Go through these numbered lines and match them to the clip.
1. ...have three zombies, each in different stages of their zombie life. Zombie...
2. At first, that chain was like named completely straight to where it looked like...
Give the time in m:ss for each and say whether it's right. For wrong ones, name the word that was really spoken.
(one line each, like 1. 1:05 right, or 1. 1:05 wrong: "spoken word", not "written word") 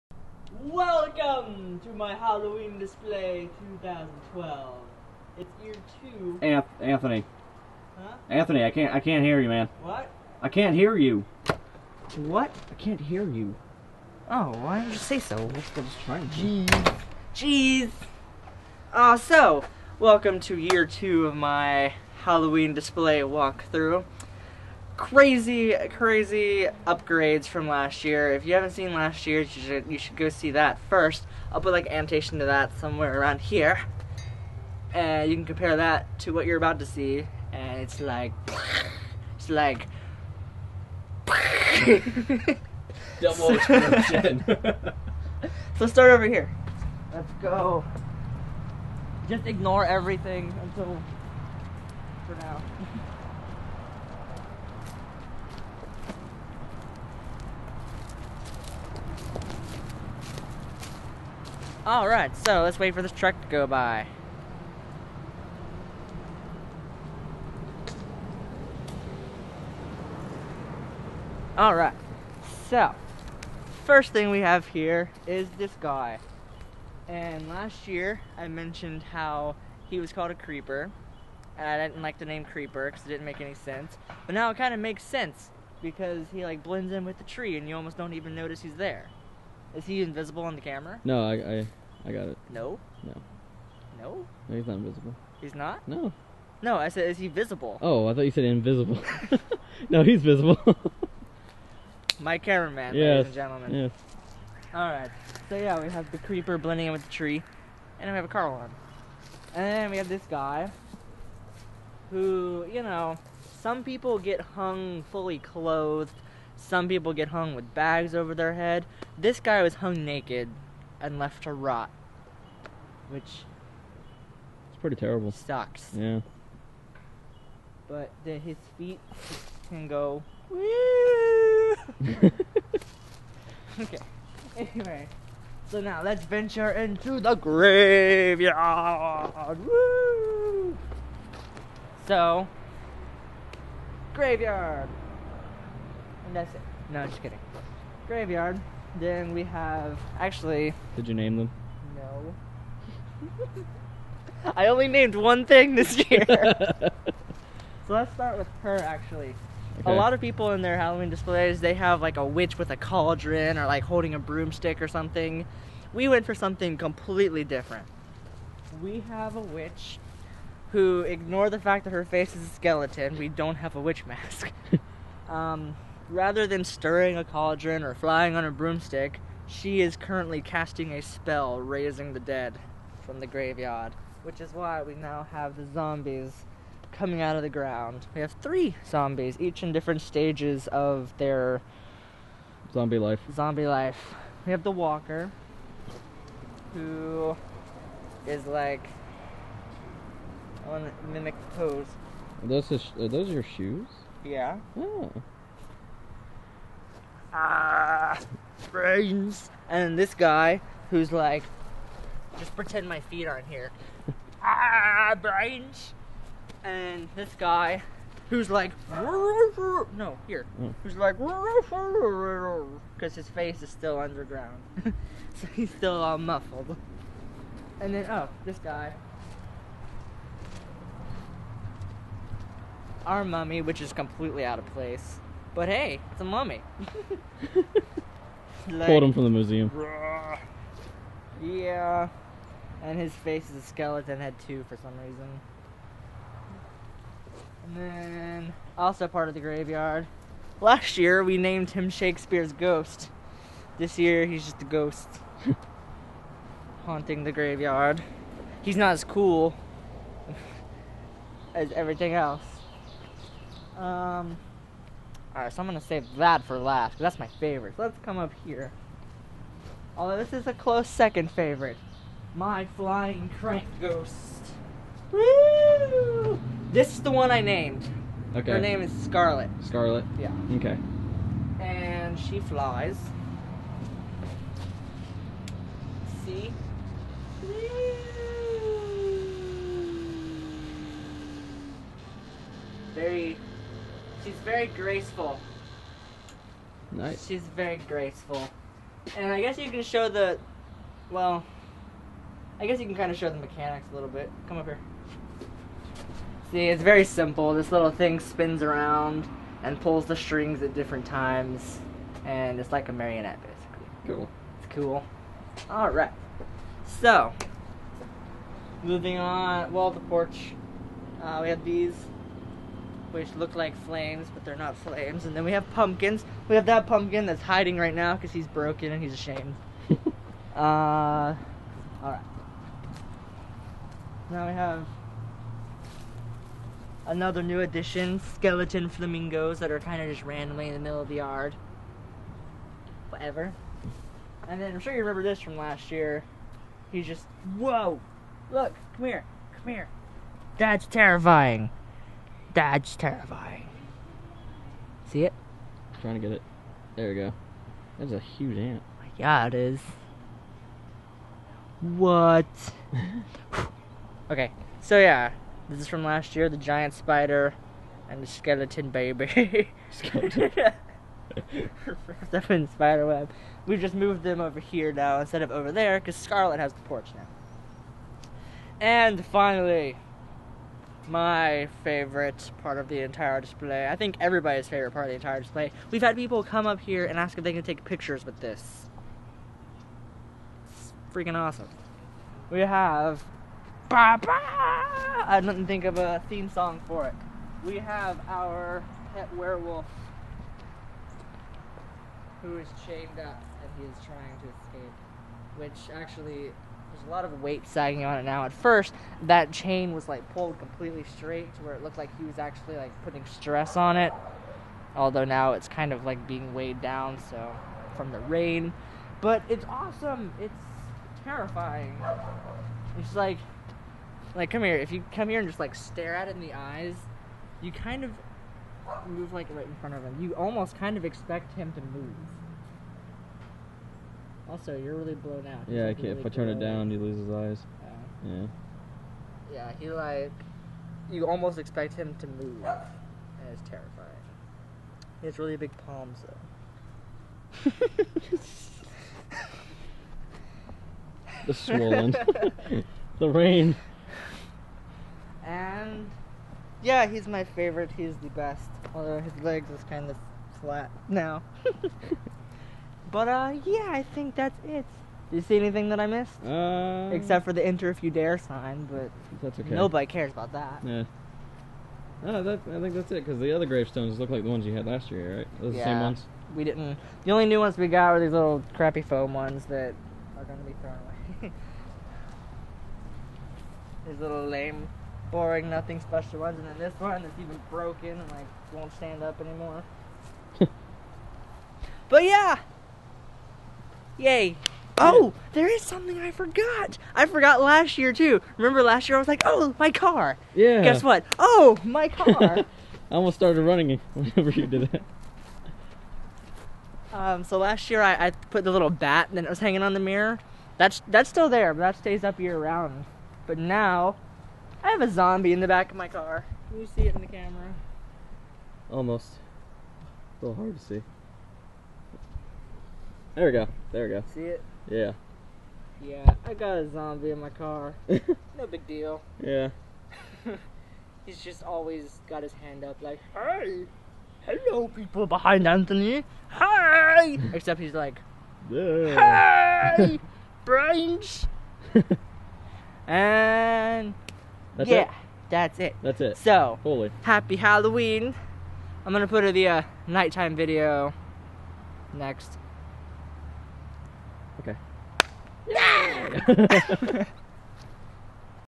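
1. 3:08 right
2. 6:48 wrong: "pulled", not "named".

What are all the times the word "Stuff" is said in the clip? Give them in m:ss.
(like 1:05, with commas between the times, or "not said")
6:12.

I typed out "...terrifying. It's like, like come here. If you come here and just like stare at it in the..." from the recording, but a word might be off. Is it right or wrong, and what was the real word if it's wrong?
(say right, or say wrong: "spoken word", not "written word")
right.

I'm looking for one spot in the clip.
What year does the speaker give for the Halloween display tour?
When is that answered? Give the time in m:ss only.
0:03.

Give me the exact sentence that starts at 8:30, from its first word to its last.
That's that's still there, but that stays up year round.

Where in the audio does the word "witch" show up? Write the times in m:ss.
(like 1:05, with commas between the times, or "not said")
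2:42, 2:49, 2:53.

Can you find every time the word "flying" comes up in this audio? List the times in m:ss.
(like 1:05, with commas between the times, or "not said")
2:57, 4:32.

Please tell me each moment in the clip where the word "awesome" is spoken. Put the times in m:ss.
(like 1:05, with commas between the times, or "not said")
6:31, 6:59.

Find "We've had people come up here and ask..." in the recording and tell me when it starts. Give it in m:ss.
6:25.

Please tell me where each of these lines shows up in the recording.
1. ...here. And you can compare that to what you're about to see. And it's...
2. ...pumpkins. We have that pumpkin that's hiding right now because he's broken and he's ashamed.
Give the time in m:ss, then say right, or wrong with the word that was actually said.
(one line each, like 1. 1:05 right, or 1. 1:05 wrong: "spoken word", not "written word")
1. 0:33 right
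2. 5:25 right.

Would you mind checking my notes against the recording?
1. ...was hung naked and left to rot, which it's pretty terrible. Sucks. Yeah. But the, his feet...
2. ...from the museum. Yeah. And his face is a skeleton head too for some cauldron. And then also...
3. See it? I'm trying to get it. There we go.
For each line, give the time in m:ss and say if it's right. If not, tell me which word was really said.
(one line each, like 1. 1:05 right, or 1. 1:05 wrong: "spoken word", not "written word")
1. 1:59 right
2. 3:59 wrong: "reason", not "cauldron"
3. 5:55 right.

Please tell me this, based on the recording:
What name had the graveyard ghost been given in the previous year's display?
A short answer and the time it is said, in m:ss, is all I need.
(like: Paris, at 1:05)
Shakespeare's ghost, at 4:11.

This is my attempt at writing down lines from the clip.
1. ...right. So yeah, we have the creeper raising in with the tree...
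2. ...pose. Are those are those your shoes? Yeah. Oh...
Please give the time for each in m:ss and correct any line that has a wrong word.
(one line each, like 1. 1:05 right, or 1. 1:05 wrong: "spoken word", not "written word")
1. 1:44 wrong: "blending", not "raising"
2. 3:21 right.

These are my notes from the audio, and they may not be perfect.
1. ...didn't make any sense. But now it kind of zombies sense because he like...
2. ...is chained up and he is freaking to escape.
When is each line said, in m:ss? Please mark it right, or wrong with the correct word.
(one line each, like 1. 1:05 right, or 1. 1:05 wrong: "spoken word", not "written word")
1. 1:23 wrong: "makes", not "zombies"
2. 6:42 wrong: "trying", not "freaking".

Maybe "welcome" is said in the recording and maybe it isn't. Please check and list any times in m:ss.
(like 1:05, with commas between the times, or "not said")
0:00, 0:19.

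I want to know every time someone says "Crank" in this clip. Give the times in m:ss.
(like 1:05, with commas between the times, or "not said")
4:33.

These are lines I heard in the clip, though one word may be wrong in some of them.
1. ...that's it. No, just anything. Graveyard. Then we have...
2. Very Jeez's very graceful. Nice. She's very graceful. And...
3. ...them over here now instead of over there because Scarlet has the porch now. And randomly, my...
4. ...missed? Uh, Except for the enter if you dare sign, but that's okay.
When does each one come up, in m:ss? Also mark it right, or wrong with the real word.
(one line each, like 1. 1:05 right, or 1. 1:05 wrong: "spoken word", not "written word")
1. 2:26 wrong: "kidding", not "anything"
2. 4:52 wrong: "She", not "Jeez"
3. 6:14 wrong: "finally", not "randomly"
4. 7:46 right.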